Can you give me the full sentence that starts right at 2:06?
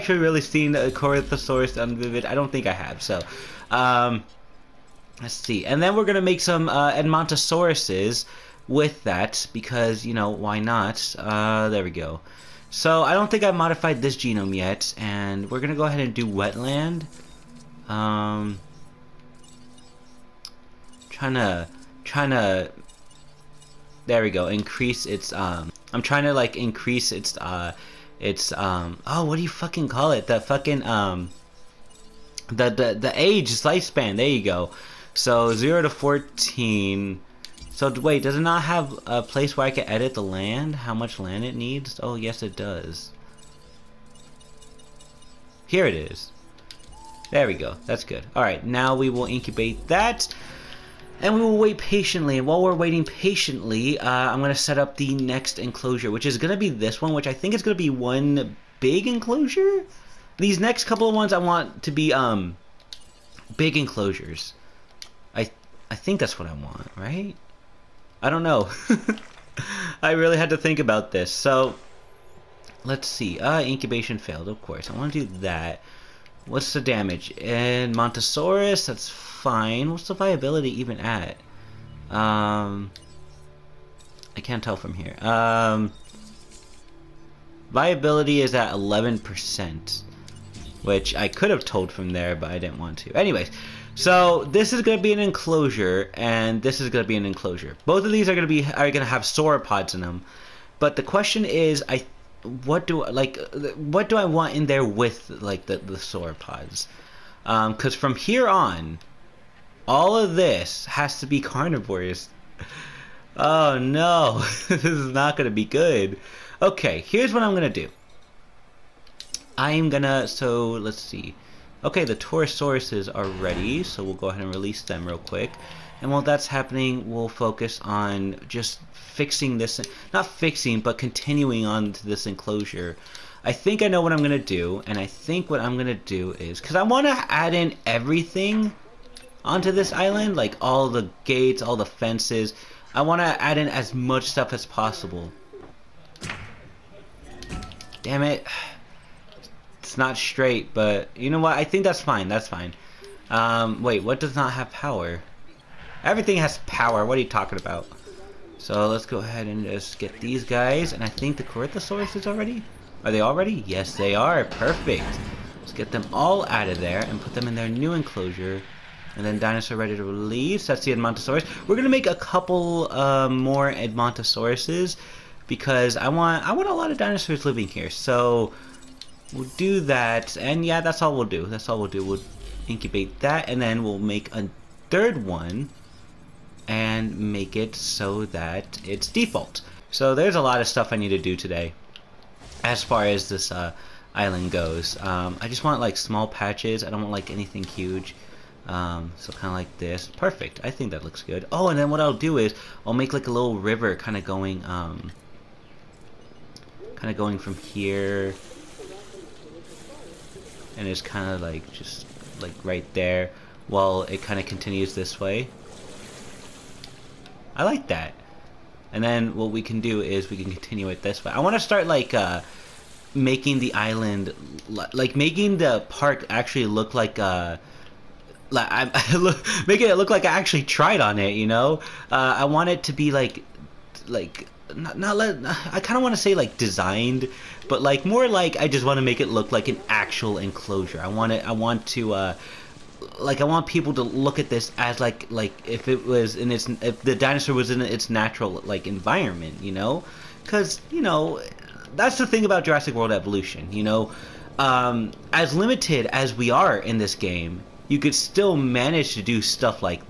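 And while that's happening, we'll focus on just fixing this, not fixing, but continuing on to this enclosure.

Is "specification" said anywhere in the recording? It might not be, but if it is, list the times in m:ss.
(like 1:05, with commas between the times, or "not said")
not said.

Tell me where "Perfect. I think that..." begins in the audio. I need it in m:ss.
3:20.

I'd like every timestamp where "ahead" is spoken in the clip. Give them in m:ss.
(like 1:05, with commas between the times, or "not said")
0:15, 2:04, 2:39.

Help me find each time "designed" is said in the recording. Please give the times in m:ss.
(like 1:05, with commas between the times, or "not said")
3:56.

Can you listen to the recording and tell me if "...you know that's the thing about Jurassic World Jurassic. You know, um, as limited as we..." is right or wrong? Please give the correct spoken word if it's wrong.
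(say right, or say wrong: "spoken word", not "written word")
wrong: "Evolution", not "Jurassic".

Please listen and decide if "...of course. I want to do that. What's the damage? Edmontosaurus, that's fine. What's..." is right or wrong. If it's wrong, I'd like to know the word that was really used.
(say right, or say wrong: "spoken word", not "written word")
right.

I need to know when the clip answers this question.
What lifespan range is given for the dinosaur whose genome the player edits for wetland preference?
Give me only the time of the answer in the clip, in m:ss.
0:35.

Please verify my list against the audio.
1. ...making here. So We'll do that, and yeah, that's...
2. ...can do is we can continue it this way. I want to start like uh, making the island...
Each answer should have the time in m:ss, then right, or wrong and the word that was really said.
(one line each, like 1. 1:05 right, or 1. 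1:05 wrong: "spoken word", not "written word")
1. 2:57 wrong: "living", not "making"
2. 3:39 right.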